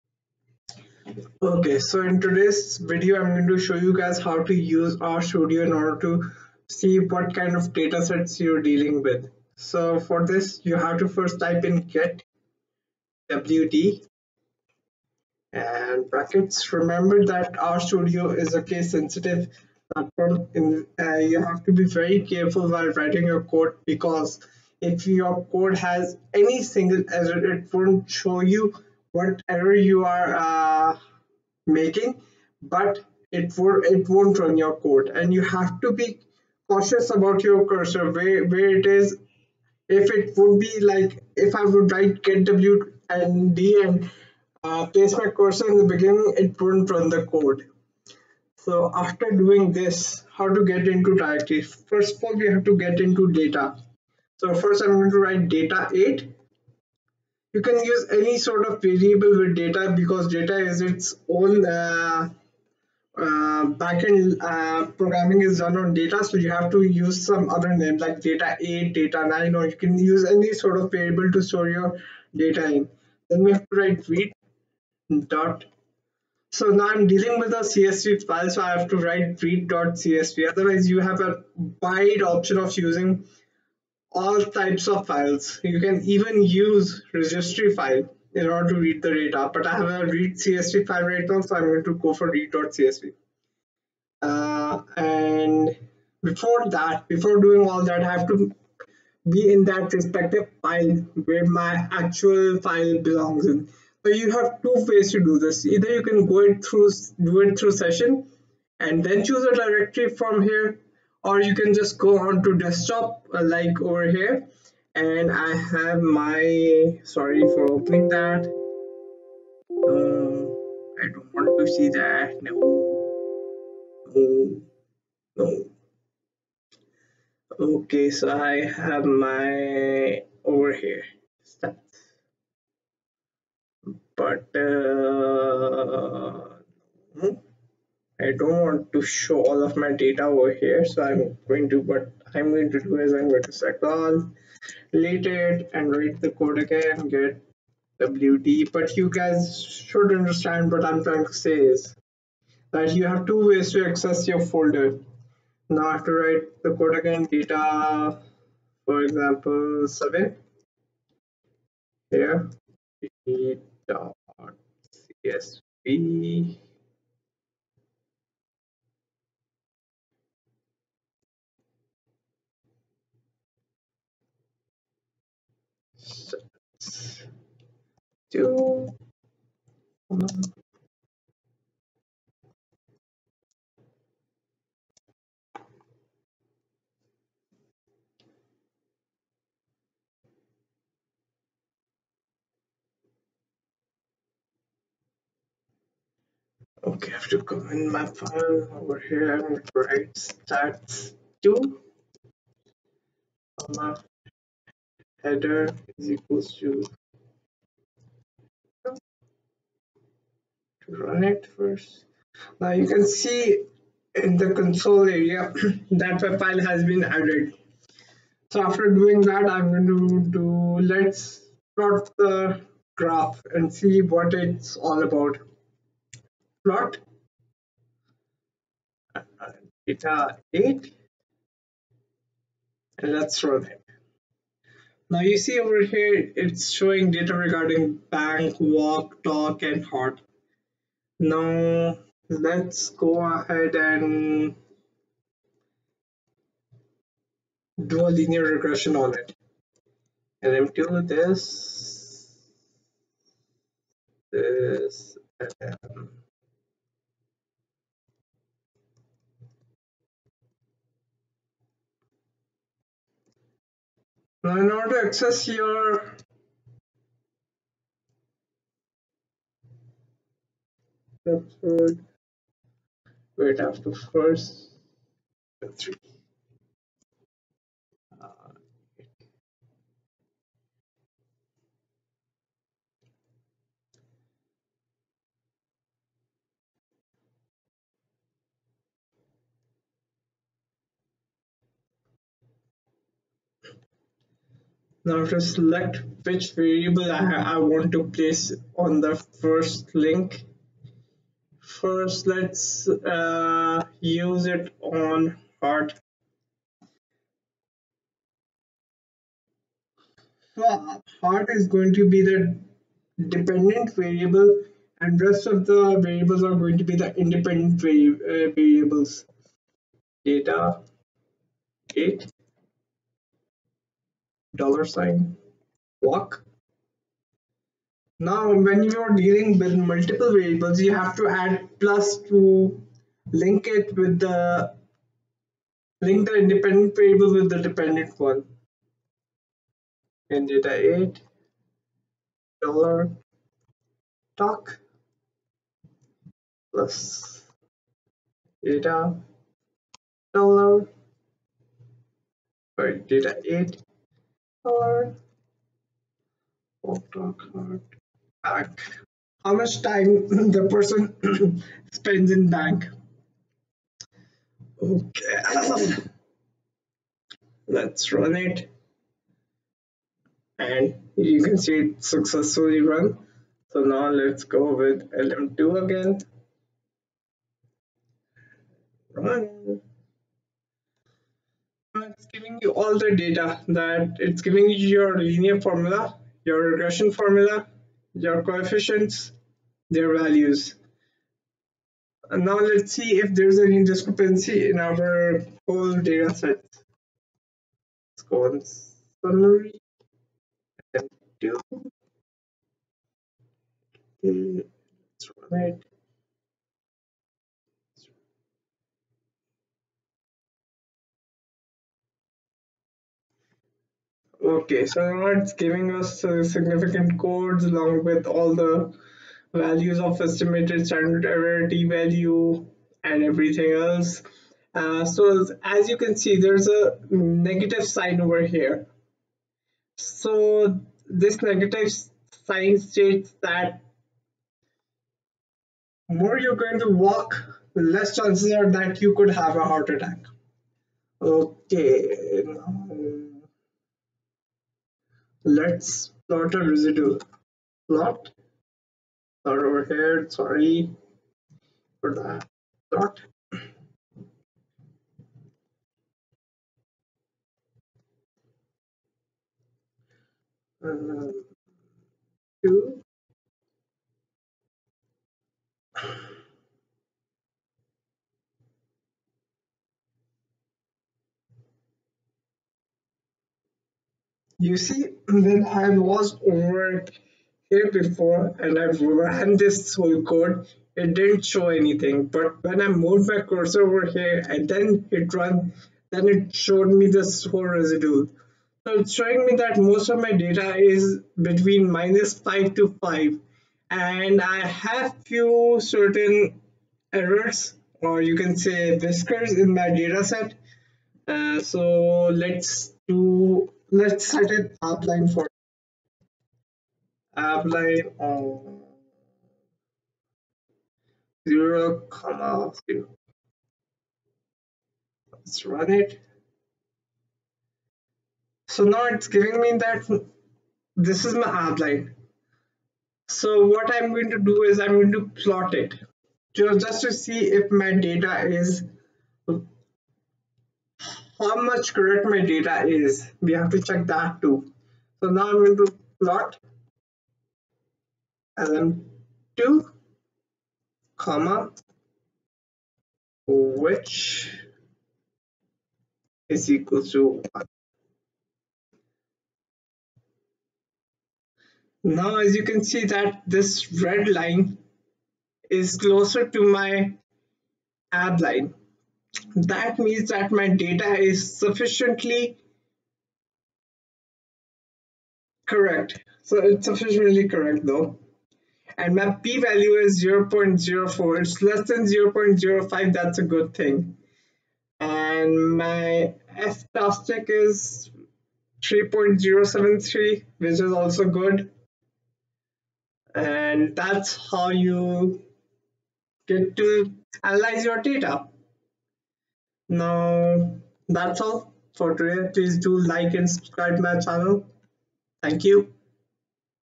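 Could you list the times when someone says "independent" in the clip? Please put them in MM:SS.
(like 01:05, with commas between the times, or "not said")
05:17, 05:36.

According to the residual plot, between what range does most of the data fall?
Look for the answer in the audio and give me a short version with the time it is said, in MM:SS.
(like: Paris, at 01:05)
-5 to 5, at 08:11.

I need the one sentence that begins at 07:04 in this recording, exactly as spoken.
Uh, so as you can see, there's a negative sign over here.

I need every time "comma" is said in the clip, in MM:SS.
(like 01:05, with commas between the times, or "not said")
03:23, 08:32, 09:01.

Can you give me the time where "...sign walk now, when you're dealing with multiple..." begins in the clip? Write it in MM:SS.
05:24.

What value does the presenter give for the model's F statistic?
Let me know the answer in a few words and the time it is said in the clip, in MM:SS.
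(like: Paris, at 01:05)
3.073, at 09:38.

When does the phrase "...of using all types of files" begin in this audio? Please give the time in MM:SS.
01:22.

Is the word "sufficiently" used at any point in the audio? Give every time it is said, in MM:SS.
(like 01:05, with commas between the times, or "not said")
09:21, 09:26.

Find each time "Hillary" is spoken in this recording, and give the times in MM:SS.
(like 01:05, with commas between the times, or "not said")
not said.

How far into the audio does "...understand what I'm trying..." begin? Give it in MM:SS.
02:30.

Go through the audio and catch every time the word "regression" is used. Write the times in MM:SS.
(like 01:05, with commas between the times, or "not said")
04:08, 06:26.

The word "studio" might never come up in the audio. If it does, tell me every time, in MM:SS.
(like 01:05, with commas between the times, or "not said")
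00:05, 00:17.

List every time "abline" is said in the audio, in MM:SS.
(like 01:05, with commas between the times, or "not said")
08:27, 08:41.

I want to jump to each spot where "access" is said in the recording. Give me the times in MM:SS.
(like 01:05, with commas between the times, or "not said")
02:33, 04:25.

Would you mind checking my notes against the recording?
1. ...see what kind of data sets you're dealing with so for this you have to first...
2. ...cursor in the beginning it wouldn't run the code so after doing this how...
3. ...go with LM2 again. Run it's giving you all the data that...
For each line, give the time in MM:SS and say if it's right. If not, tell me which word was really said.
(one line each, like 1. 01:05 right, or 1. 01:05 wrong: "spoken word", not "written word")
1. 00:06 right
2. 00:45 right
3. 06:14 right.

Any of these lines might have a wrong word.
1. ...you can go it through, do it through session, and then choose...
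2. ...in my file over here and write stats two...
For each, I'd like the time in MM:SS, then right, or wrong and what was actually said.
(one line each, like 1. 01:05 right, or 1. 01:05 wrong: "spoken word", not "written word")
1. 01:45 right
2. 03:17 right.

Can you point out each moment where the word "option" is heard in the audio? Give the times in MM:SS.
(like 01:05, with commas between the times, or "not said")
01:22.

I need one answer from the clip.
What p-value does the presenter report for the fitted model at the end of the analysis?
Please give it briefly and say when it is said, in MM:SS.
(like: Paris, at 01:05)
0.04, at 09:30.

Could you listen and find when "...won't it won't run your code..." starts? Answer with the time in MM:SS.
00:33.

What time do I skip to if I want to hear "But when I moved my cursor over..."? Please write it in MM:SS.
08:02.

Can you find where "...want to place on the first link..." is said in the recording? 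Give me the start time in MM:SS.
04:57.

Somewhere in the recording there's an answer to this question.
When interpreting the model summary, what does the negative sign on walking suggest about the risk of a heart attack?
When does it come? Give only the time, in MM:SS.
07:17.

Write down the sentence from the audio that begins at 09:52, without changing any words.
Please do like and subscribe my channel.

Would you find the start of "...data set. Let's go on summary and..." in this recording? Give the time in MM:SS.
06:36.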